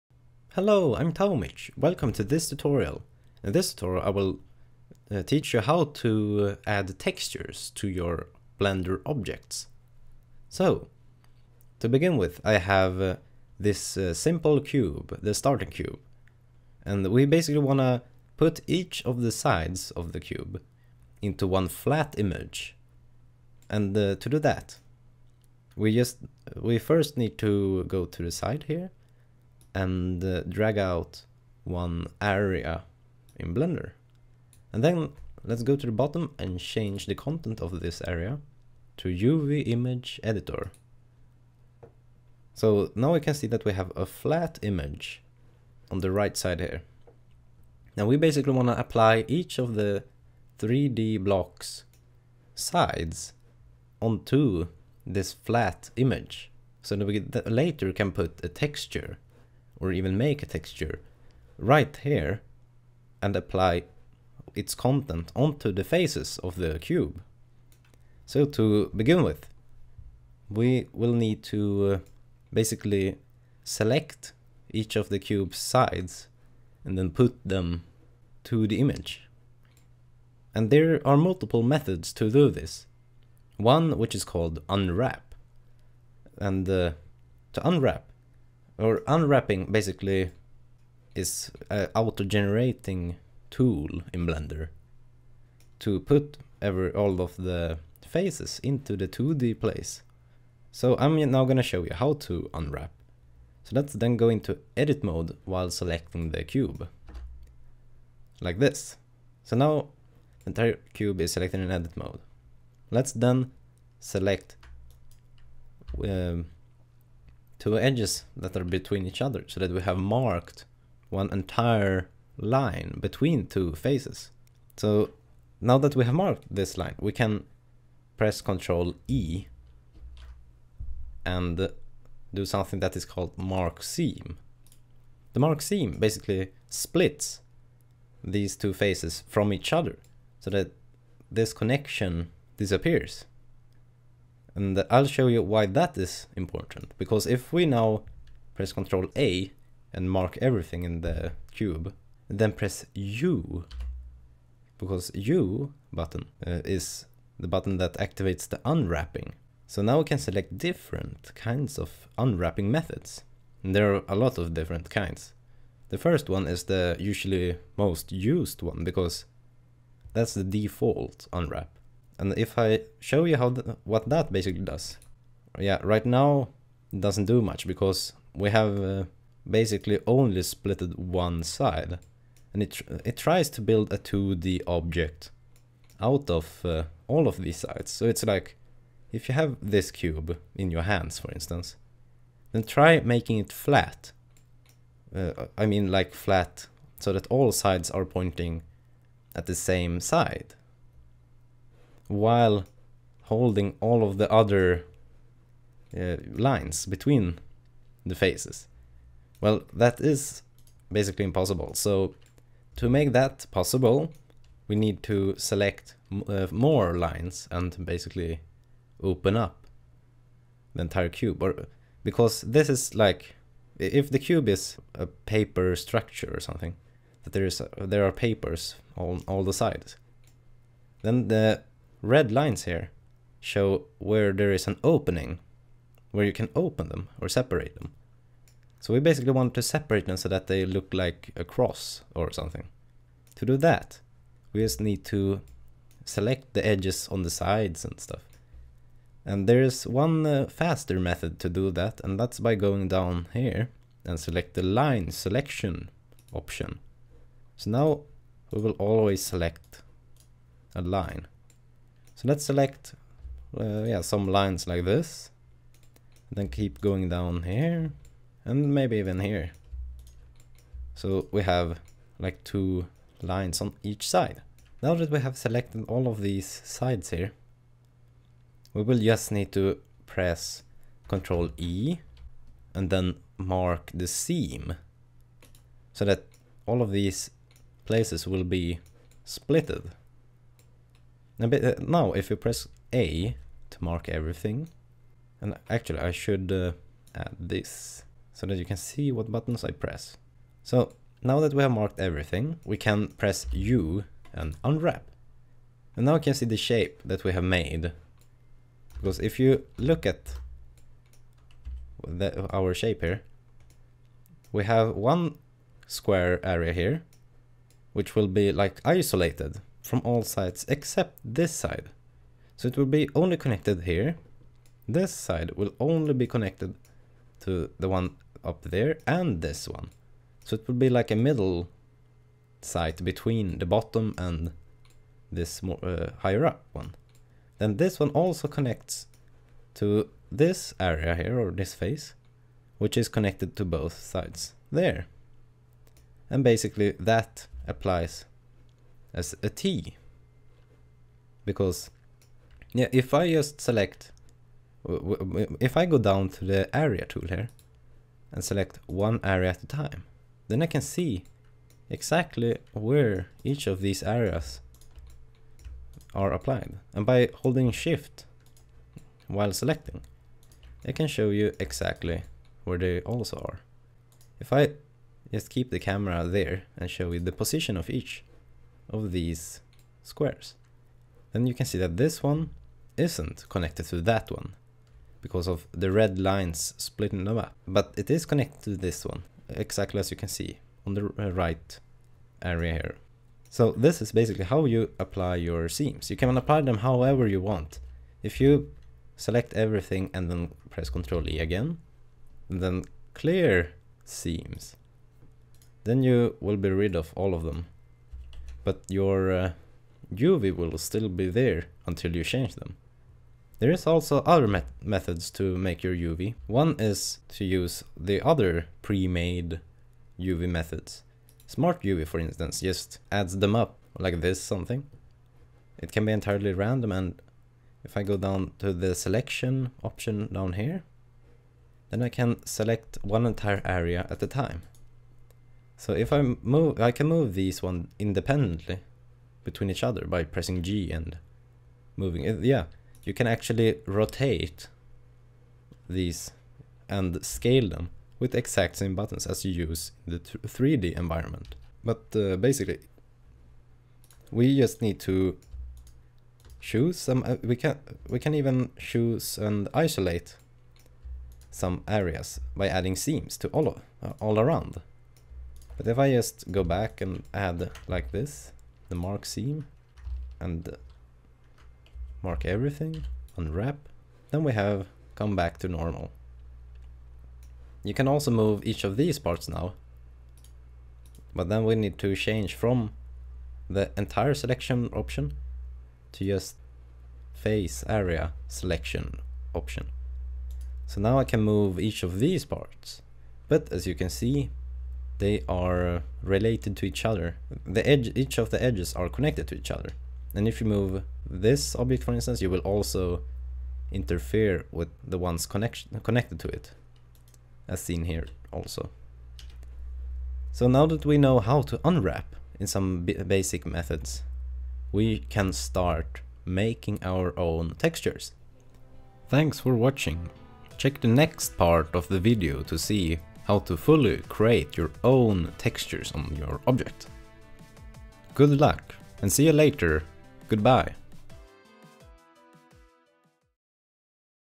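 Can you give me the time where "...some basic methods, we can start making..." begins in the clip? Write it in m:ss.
8:32.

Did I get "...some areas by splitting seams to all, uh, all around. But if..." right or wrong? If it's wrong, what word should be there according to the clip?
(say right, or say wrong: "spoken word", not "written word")
wrong: "adding", not "splitting".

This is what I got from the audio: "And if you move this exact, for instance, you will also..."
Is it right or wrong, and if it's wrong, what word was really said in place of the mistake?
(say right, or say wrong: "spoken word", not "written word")
wrong: "object", not "exact".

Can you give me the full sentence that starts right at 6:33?
So this is basically how you apply your seams.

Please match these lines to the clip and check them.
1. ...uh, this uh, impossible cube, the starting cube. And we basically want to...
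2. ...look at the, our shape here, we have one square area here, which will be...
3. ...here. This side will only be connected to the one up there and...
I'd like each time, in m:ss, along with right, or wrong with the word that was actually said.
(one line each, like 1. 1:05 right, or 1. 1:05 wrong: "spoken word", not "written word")
1. 0:12 wrong: "simple", not "impossible"
2. 5:09 right
3. 5:23 right.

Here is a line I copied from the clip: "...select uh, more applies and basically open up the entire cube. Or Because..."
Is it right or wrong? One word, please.
wrong.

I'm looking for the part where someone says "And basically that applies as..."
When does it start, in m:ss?
5:46.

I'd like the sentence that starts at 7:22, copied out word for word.
Yeah, you can actually rotate these and scale them with exact same buttons as you use in the 3D environment.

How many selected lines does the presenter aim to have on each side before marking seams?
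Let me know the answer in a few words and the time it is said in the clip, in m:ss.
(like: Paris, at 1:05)
2, at 4:32.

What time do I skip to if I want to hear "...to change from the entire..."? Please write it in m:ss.
8:01.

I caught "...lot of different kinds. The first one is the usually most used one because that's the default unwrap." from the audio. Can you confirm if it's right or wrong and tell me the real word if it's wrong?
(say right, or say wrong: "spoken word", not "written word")
right.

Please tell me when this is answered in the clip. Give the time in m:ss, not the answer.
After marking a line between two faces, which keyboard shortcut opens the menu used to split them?
2:08.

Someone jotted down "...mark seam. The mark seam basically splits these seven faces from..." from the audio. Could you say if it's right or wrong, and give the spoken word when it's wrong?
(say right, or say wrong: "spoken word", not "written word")
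wrong: "two", not "seven".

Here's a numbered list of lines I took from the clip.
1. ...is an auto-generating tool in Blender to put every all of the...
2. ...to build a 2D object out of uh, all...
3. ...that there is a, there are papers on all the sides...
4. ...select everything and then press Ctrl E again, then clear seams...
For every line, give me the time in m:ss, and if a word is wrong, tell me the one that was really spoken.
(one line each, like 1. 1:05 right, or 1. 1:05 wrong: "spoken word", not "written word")
1. 1:31 right
2. 3:03 right
3. 3:47 right
4. 6:39 right.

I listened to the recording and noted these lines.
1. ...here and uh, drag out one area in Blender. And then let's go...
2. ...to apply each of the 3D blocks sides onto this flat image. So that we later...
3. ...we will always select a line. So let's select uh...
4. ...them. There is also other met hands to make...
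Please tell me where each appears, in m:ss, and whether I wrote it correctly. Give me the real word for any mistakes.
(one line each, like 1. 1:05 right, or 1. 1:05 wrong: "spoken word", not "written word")
1. 0:28 right
2. 0:48 right
3. 4:18 right
4. 6:52 wrong: "methods", not "hands".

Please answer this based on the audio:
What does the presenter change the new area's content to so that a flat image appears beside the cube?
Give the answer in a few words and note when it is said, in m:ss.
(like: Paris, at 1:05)
UV image editor, at 0:39.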